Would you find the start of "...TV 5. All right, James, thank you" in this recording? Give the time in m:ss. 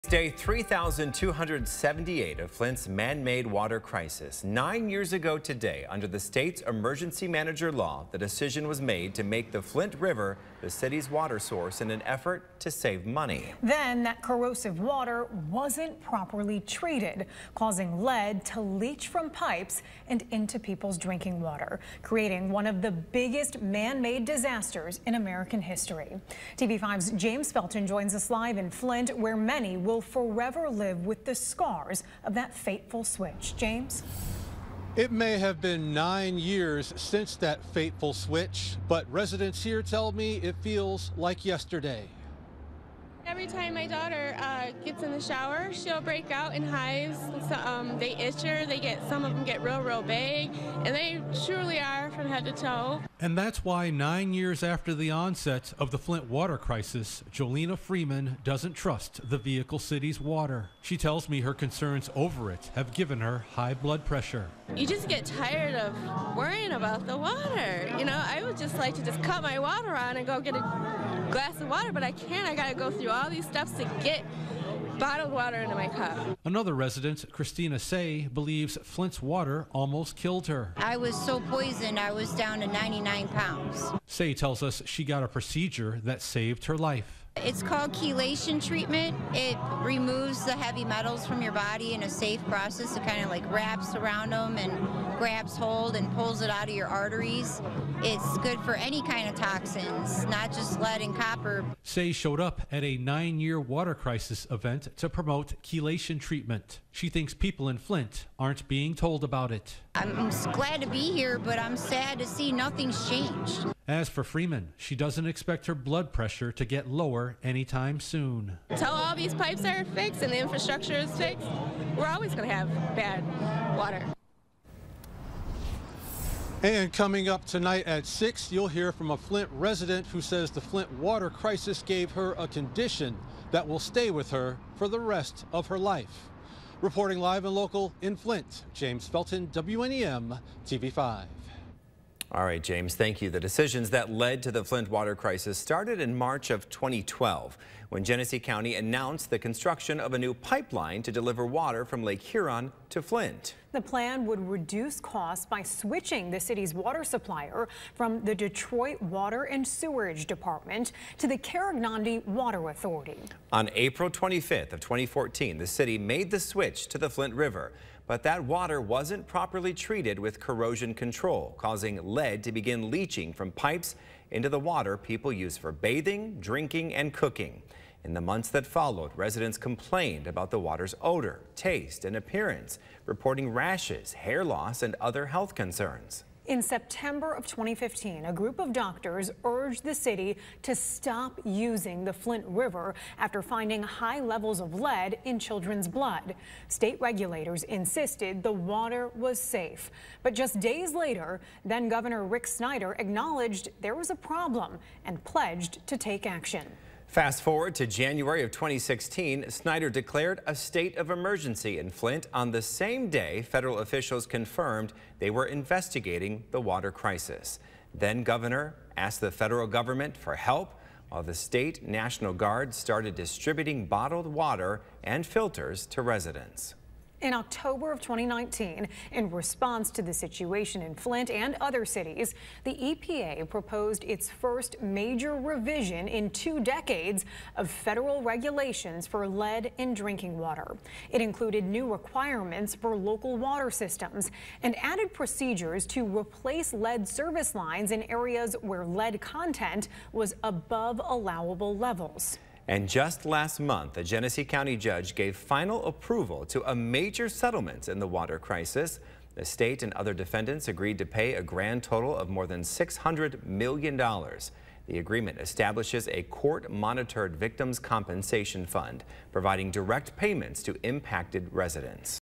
2:20.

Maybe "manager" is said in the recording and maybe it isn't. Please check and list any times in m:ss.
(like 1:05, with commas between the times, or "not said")
0:07.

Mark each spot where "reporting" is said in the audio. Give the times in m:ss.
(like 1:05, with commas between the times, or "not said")
2:16, 3:03.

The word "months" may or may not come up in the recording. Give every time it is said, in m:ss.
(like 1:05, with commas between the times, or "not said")
2:58, 4:13.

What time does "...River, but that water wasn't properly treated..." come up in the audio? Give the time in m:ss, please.
2:47.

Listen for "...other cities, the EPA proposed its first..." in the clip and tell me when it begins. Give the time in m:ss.
3:51.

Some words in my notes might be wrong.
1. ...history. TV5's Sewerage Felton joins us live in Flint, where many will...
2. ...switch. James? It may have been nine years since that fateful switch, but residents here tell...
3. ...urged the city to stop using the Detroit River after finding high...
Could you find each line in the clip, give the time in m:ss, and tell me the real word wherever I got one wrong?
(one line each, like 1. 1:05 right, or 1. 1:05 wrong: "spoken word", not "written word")
1. 0:25 wrong: "James", not "Sewerage"
2. 0:33 right
3. 3:09 wrong: "Flint", not "Detroit".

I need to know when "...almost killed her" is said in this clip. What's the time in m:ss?
1:19.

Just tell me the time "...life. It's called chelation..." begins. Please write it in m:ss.
1:26.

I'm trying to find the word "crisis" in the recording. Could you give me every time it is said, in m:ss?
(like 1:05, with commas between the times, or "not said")
0:03, 0:56, 1:43, 2:11, 2:25, 3:36, 4:18.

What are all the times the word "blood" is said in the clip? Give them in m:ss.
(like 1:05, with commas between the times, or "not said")
1:03, 1:55, 3:15.